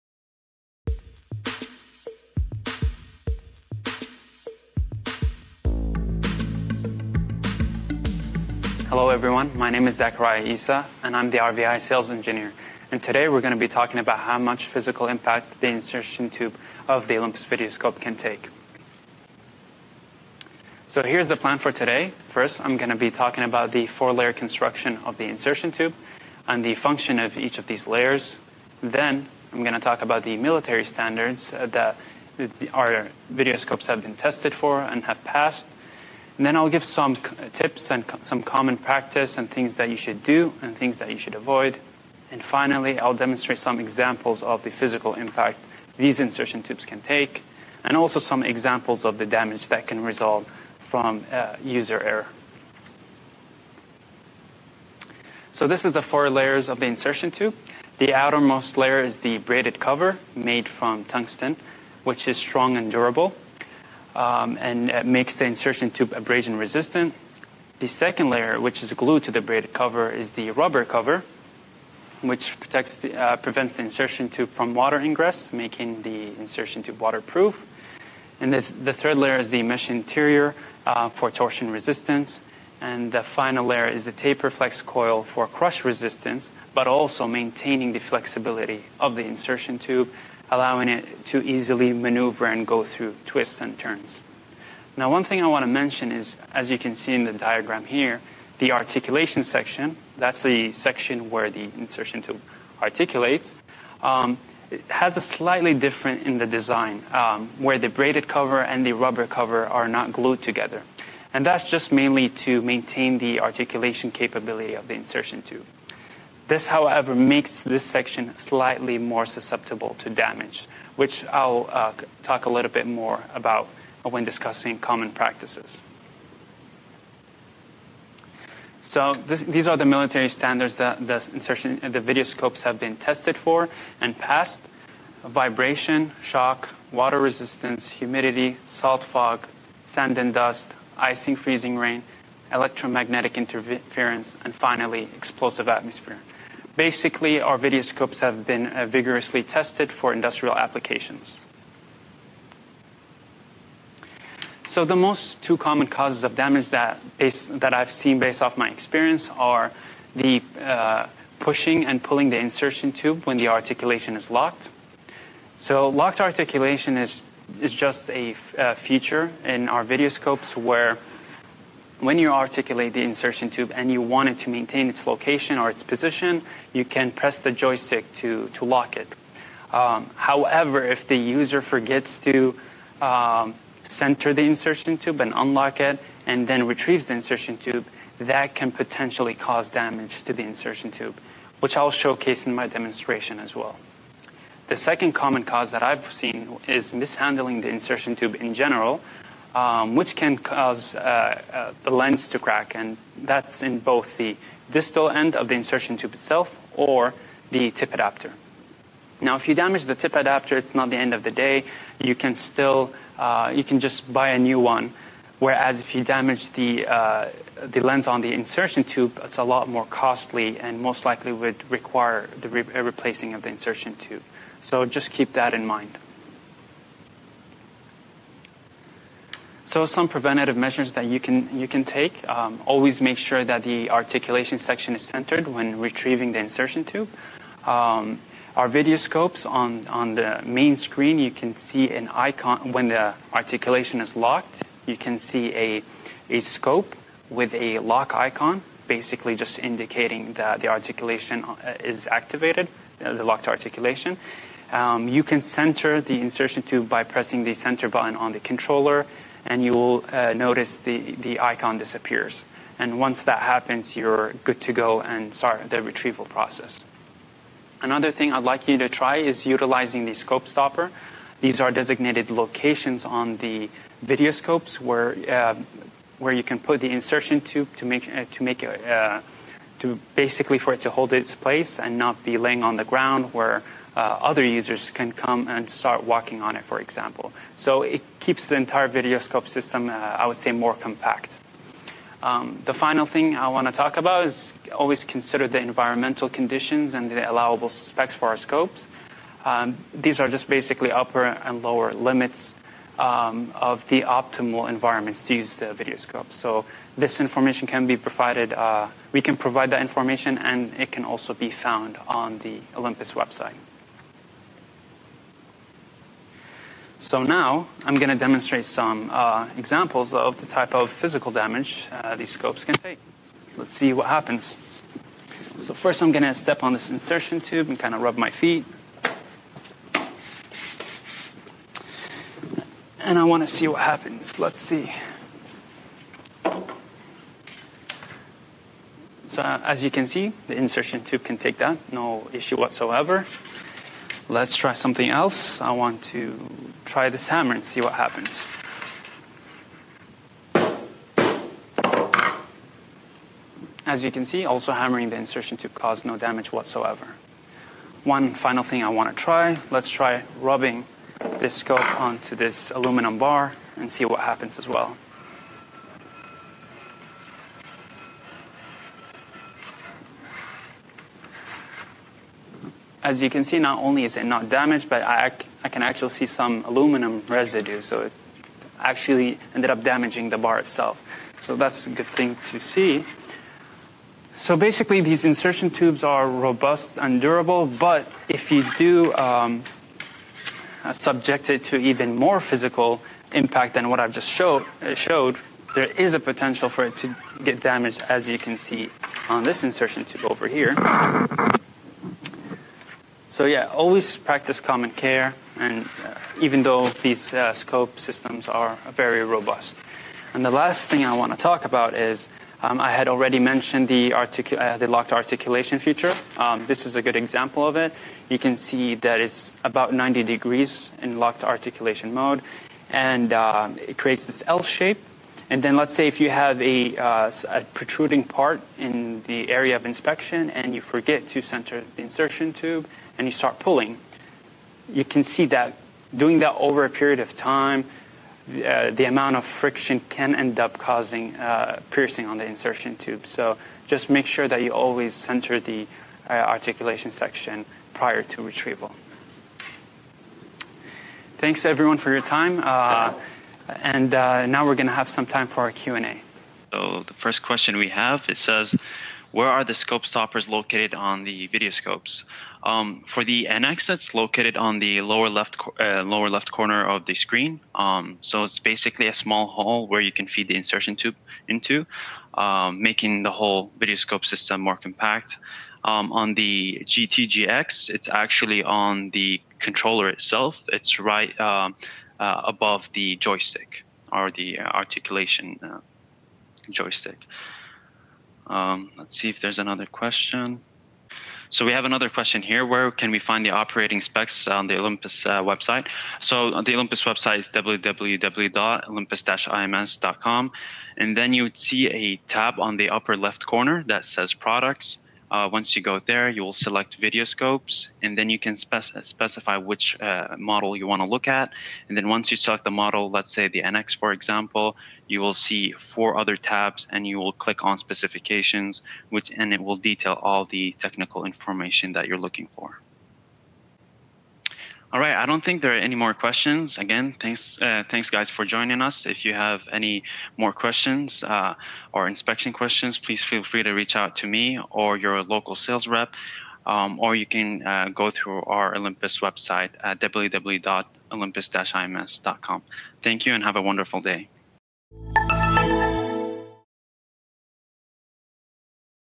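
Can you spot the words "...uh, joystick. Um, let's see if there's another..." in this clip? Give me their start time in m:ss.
8:05.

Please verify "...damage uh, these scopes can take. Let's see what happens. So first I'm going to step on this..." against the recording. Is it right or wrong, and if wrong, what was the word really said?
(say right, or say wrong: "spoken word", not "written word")
right.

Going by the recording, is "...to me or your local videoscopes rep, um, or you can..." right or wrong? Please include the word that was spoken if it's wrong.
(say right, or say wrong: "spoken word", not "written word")
wrong: "sales", not "videoscopes".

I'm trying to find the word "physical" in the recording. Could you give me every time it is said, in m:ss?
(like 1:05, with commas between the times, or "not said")
0:14, 0:44, 5:20, 6:32.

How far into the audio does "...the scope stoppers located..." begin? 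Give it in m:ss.
7:39.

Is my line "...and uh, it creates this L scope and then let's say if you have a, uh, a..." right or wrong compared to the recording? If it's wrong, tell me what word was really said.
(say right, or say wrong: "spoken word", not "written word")
wrong: "shape", not "scope".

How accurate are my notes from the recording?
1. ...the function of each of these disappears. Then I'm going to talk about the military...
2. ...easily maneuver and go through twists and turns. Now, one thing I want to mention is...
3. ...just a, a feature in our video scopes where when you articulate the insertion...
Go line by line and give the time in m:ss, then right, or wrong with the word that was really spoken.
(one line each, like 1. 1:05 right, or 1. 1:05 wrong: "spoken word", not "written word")
1. 0:26 wrong: "layers", not "disappears"
2. 1:31 right
3. 2:47 right.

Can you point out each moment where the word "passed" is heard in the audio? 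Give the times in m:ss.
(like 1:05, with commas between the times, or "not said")
0:35, 2:14.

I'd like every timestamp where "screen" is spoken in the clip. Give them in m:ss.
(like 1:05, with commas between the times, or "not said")
4:00, 7:47.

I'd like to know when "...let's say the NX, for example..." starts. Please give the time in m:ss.
8:33.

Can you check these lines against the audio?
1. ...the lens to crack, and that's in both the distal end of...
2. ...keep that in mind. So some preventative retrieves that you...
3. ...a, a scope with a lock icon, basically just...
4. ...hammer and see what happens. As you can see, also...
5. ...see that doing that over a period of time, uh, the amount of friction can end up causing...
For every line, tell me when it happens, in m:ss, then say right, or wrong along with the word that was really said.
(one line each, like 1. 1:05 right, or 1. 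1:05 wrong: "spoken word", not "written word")
1. 3:21 right
2. 3:45 wrong: "measures", not "retrieves"
3. 4:05 right
4. 5:47 right
5. 7:15 right.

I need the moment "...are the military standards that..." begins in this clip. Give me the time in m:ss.
2:09.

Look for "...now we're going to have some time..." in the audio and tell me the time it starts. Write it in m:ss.
7:34.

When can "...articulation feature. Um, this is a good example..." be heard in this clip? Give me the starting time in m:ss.
6:55.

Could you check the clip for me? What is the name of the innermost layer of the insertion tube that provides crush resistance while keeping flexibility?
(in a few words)
Taper flex coil.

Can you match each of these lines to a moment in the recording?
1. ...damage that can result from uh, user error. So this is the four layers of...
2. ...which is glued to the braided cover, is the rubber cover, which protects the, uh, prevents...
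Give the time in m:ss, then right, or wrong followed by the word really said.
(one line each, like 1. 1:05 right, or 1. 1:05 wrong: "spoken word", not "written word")
1. 0:49 right
2. 1:08 right.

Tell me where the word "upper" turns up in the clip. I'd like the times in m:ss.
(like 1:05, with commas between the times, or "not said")
5:00, 8:22.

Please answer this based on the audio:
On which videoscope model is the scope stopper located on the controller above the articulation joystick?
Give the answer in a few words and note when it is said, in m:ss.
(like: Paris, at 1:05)
GTGX, at 7:56.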